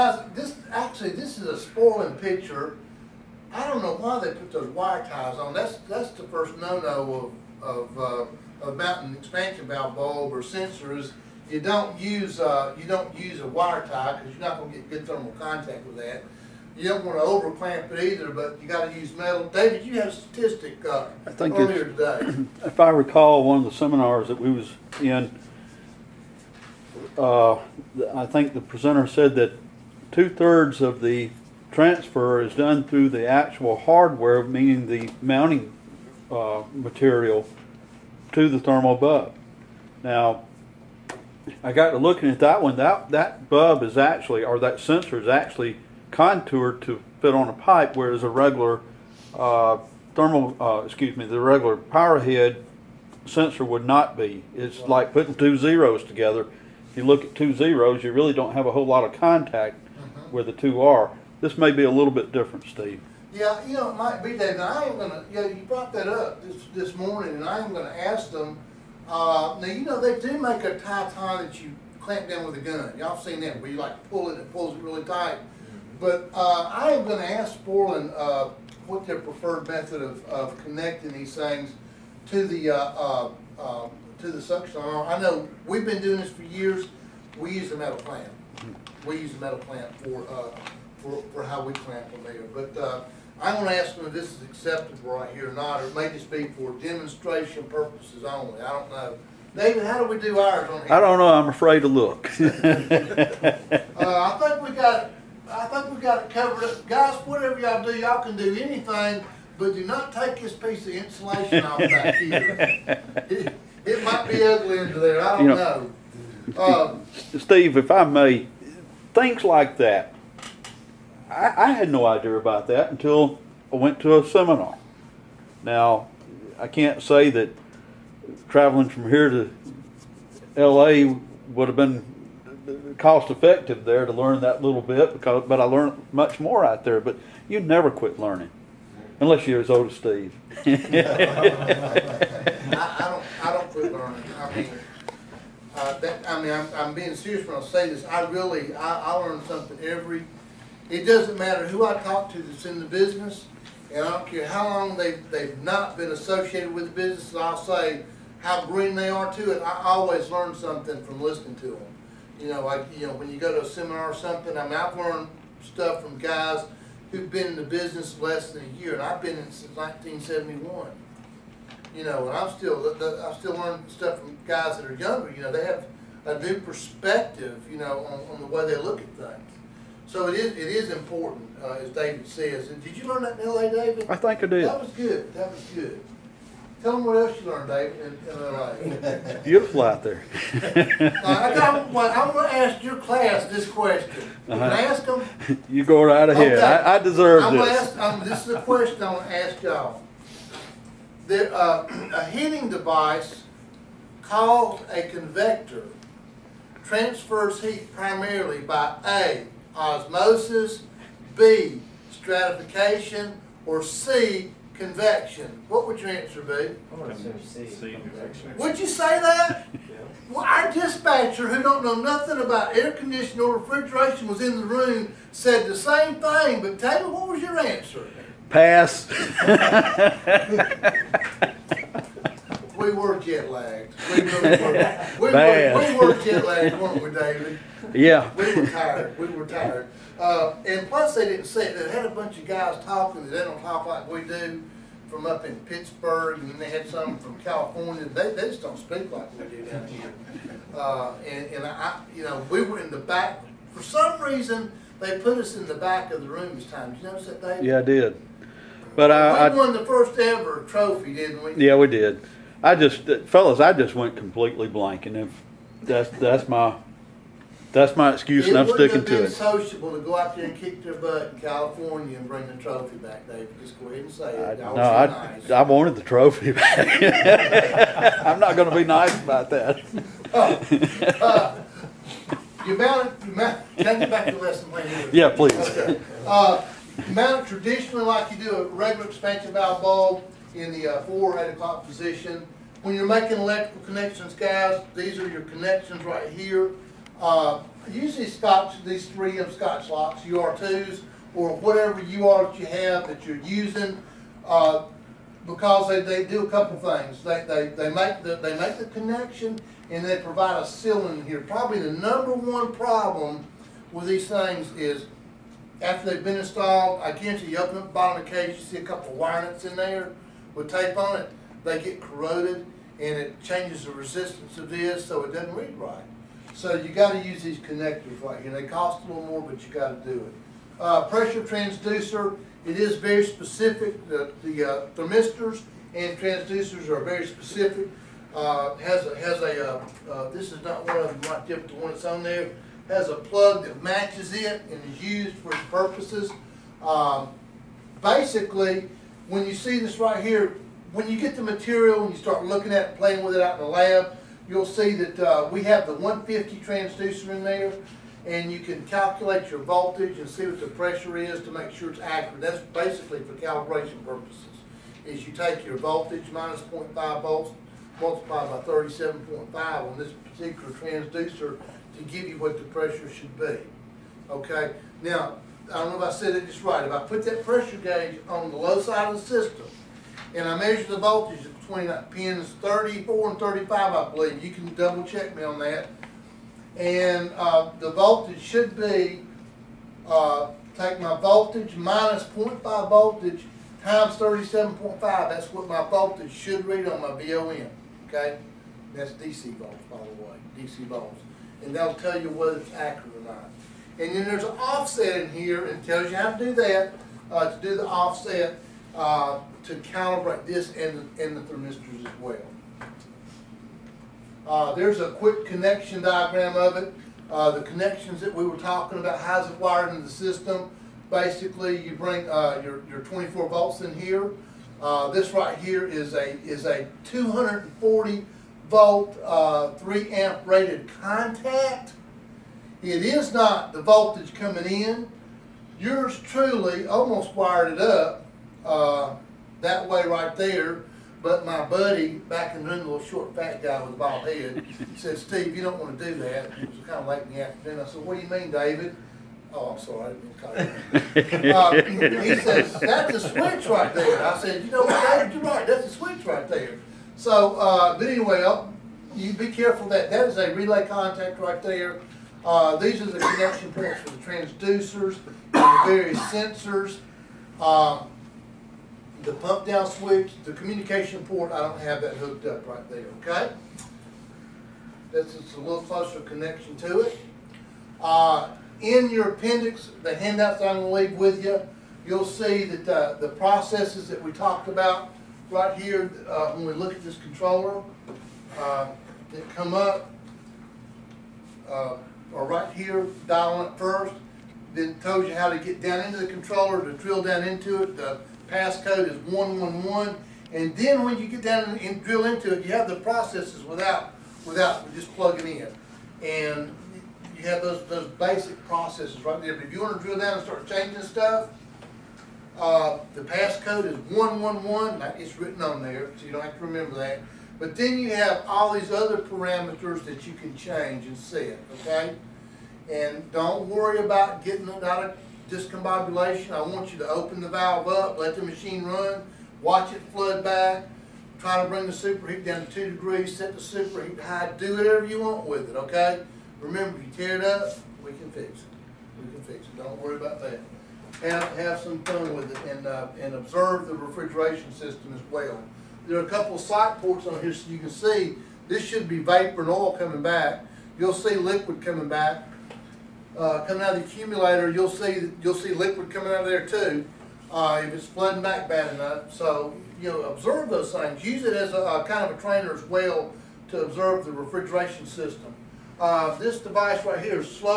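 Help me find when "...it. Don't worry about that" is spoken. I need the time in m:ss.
8:59.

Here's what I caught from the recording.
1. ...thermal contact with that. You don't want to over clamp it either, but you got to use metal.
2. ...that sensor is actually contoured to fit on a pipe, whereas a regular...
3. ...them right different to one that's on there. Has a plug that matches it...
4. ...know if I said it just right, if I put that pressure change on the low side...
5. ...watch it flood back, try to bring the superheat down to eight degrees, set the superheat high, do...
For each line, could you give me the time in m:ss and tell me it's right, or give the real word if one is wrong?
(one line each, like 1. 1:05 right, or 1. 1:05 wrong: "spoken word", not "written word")
1. 0:15 right
2. 0:44 right
3. 5:41 right
4. 6:15 wrong: "gauge", not "change"
5. 8:49 wrong: "two", not "eight".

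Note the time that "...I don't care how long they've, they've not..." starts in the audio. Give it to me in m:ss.
2:34.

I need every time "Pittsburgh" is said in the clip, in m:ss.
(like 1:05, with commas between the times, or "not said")
4:05.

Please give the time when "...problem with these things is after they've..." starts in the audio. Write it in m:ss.
5:12.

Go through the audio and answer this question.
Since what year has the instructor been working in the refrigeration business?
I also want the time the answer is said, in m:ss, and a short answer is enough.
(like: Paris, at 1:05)
1971, at 2:49.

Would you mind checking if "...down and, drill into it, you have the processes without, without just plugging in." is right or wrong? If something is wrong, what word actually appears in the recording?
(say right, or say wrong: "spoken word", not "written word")
right.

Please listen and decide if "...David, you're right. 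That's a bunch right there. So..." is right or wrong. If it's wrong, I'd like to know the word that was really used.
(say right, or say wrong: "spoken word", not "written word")
wrong: "switch", not "bunch".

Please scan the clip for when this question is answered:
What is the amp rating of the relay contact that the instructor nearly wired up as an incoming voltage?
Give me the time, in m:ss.
7:09.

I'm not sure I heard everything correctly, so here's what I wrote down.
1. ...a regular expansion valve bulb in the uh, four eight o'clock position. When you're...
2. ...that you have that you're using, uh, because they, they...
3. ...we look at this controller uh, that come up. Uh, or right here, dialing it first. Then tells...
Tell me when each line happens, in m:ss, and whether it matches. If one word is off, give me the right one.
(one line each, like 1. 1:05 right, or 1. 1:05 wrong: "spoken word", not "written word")
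1. 4:48 right
2. 5:02 right
3. 8:06 right.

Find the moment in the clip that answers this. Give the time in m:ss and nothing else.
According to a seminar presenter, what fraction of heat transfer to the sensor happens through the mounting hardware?
0:30.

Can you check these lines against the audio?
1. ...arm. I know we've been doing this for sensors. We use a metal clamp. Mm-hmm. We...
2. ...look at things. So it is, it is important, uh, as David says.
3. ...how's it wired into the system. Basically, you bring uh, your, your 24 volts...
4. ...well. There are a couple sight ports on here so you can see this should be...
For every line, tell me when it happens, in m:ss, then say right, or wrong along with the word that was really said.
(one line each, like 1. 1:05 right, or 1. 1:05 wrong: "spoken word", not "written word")
1. 1:24 wrong: "years", not "sensors"
2. 2:58 right
3. 6:59 right
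4. 9:05 right.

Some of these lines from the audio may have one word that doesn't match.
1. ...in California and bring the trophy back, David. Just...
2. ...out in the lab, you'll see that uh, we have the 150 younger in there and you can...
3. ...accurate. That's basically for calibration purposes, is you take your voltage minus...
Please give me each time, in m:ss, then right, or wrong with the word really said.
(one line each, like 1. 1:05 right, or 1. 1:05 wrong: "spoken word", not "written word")
1. 4:31 right
2. 5:53 wrong: "transducer", not "younger"
3. 6:01 right.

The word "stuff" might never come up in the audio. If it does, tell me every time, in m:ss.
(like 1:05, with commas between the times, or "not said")
2:45, 2:53, 8:31.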